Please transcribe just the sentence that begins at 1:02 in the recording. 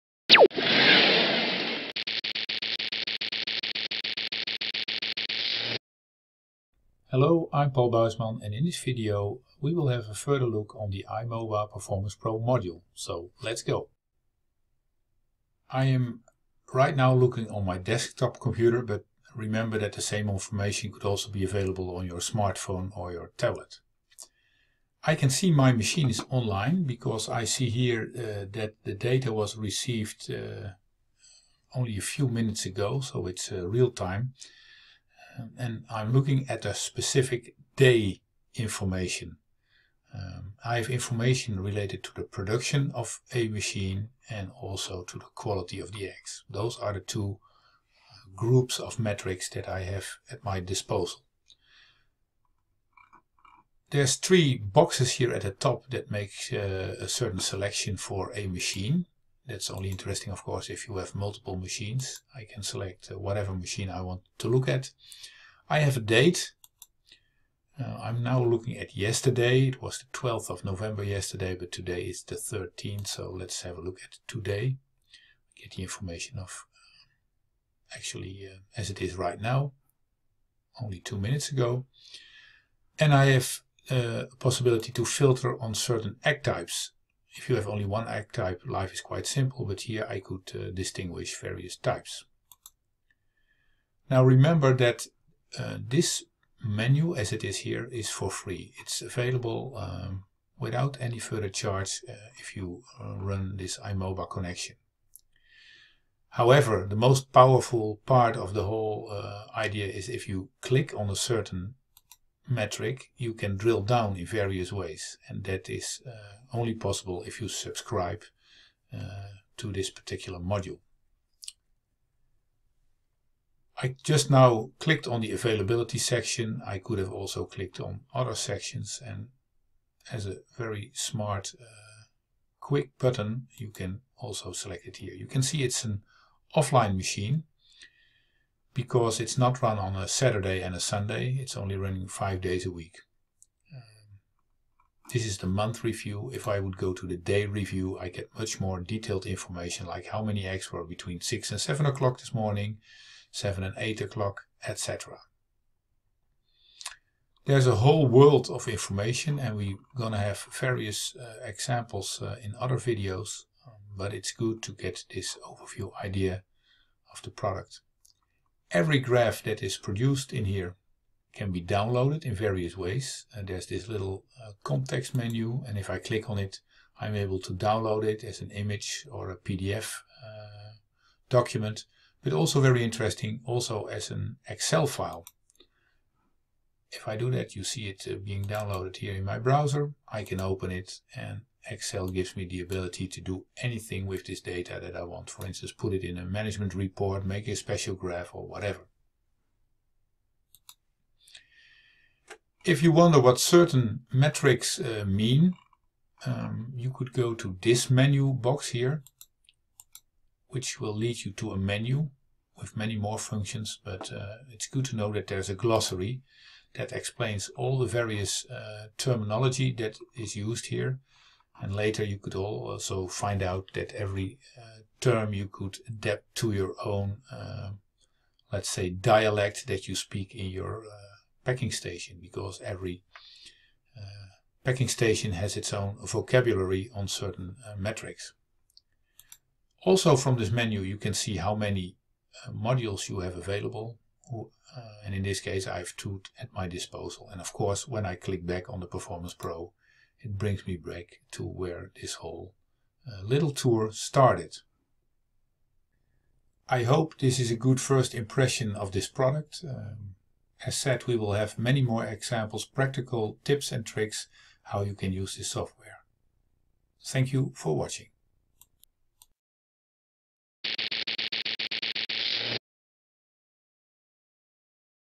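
I can select uh, whatever machine I want to look at.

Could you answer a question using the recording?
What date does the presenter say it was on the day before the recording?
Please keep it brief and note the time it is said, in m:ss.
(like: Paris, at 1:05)
12th of November, at 1:10.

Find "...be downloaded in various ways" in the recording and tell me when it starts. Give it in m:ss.
2:51.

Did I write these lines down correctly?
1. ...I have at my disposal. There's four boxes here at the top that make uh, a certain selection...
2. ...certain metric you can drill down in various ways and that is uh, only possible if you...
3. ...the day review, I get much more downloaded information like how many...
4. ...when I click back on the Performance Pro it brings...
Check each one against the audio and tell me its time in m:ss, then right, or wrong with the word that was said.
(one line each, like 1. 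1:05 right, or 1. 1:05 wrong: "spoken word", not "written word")
1. 0:49 wrong: "three", not "four"
2. 1:51 right
3. 2:27 wrong: "detailed", not "downloaded"
4. 4:07 right.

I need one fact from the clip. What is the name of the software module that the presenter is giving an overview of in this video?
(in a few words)
iMoba Performance Pro.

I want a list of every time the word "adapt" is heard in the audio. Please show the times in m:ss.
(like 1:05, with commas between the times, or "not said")
3:45.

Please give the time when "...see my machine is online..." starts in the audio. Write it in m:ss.
0:25.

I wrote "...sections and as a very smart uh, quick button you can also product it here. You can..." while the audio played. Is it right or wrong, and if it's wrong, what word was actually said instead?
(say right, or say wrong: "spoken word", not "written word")
wrong: "select", not "product".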